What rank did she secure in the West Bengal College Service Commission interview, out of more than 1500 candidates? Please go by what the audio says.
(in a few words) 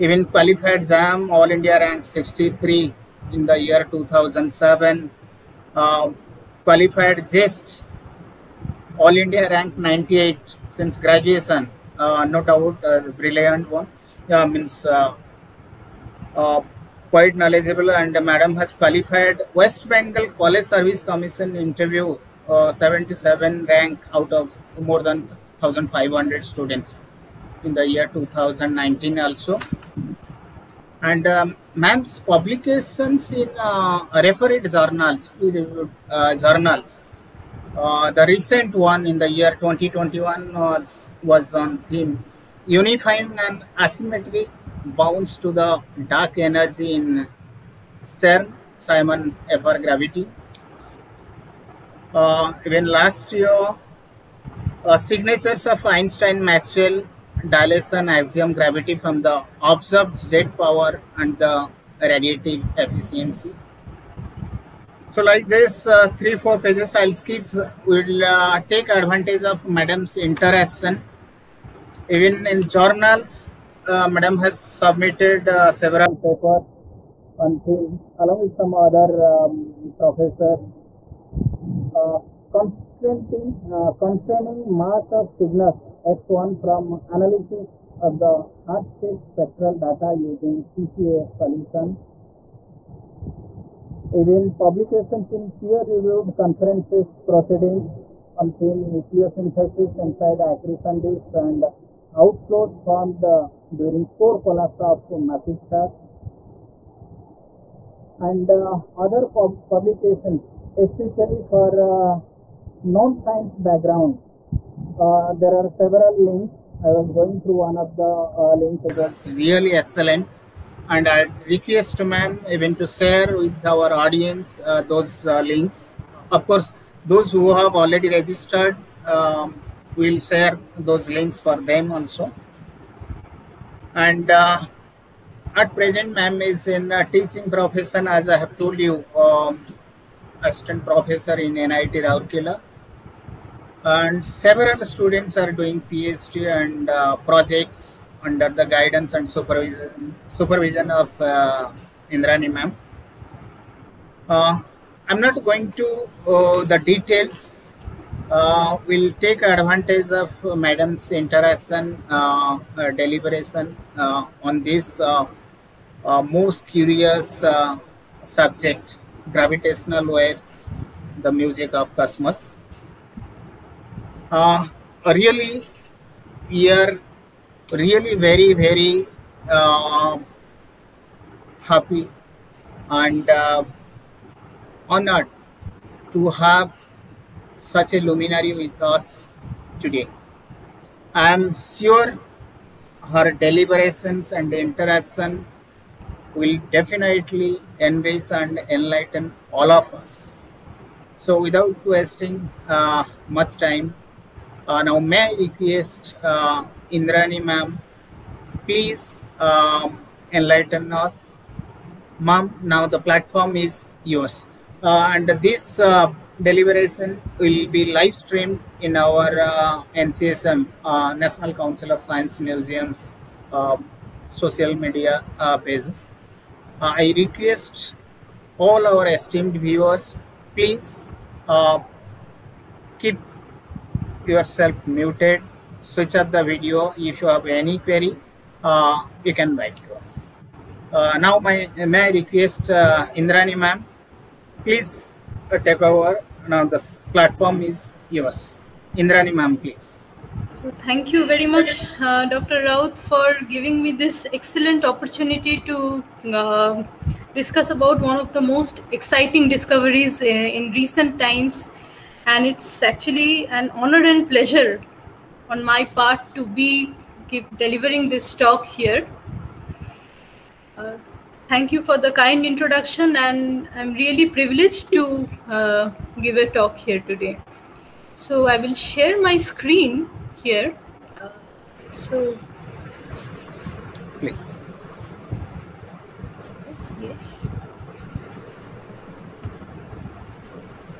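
77.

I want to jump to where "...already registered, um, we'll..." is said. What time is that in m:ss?
2:07.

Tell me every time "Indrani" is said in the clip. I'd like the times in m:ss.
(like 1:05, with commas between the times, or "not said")
2:32, 3:26, 4:03, 4:08.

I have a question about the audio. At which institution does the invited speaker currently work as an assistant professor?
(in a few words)
NIT Rourkela.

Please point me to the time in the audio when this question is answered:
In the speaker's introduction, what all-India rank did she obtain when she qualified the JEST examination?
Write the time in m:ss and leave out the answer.
0:09.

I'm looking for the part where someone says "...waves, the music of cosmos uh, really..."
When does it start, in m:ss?
2:50.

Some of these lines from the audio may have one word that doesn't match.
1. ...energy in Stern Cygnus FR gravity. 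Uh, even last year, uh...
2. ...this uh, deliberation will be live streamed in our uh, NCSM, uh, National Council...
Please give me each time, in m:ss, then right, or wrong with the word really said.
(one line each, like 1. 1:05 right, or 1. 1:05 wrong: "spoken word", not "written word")
1. 0:46 wrong: "Simon", not "Cygnus"
2. 3:35 right.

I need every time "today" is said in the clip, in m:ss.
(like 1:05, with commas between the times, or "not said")
3:09, 4:37.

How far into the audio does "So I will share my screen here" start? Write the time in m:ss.
4:38.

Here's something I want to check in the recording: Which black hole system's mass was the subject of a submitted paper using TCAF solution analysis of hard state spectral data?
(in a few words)
Cygnus X1.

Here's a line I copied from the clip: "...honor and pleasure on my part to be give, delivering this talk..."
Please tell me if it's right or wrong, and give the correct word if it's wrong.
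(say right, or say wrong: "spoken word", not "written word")
right.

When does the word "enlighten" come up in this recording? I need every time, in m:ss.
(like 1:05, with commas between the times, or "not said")
3:18, 3:30.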